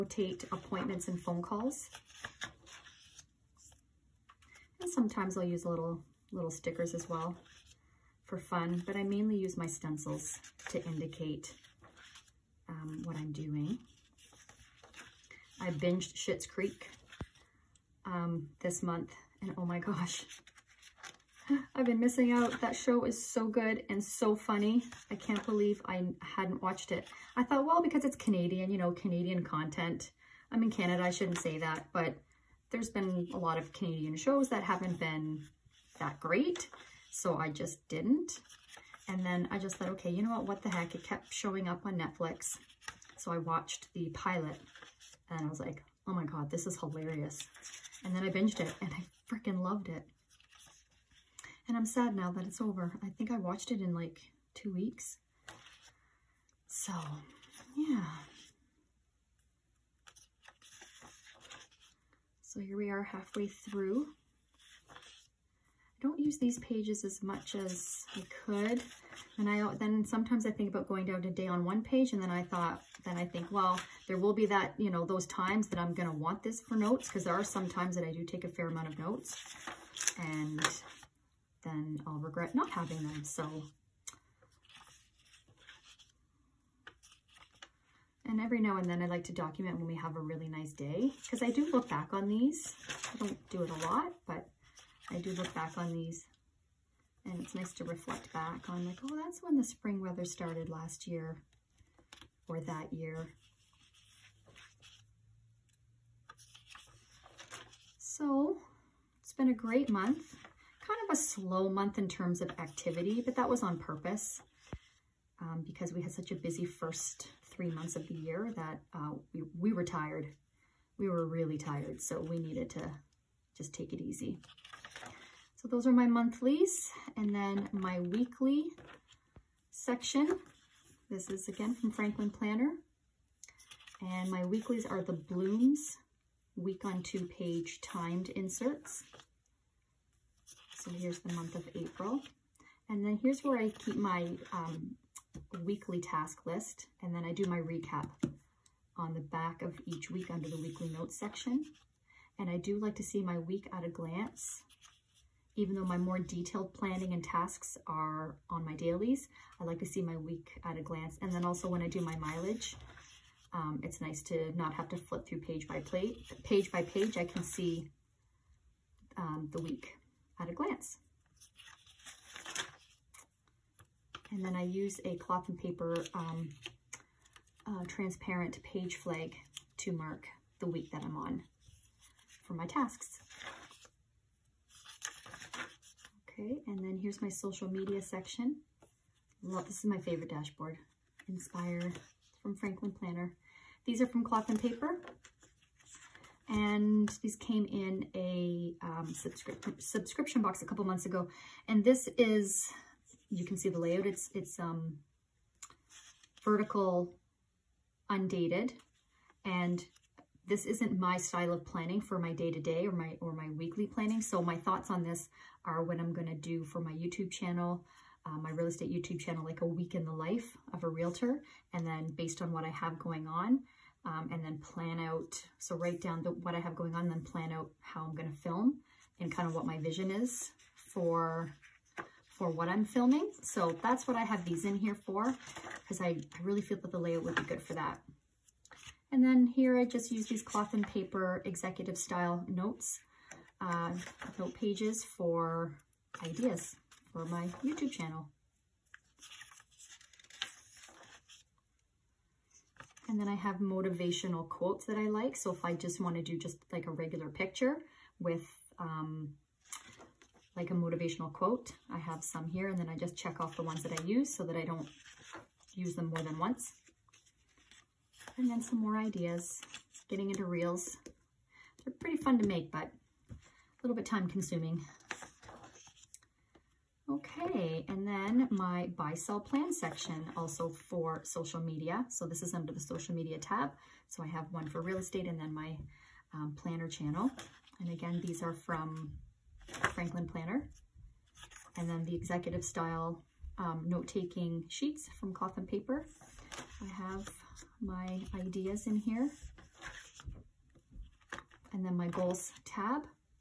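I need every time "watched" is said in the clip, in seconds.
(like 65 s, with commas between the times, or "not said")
26 s, 43 s, 53 s.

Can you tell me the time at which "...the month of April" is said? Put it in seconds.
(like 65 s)
141 s.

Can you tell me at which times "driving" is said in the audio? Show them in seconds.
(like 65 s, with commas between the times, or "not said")
not said.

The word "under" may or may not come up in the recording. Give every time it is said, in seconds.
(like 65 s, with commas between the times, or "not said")
150 s, 282 s.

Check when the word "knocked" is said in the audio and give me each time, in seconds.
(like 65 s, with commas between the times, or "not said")
not said.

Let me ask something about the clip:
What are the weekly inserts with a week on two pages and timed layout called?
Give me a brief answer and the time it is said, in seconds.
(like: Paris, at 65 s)
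Blooms, at 135 s.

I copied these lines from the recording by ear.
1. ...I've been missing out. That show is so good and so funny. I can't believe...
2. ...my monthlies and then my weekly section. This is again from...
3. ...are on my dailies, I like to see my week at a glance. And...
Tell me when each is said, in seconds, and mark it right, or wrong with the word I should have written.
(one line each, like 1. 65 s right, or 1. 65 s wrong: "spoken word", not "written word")
1. 21 s right
2. 125 s right
3. 157 s right.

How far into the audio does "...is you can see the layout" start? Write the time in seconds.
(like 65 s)
202 s.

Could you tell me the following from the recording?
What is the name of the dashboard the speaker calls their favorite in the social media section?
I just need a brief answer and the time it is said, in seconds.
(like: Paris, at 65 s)
Inspire, at 191 s.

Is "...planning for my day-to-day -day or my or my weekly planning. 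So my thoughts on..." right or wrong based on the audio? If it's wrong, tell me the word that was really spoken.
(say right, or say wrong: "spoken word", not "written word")
right.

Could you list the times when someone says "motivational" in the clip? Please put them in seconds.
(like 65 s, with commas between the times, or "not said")
253 s, 260 s.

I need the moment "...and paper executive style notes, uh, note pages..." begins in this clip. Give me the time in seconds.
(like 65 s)
240 s.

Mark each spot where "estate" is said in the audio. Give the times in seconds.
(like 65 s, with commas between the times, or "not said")
218 s, 284 s.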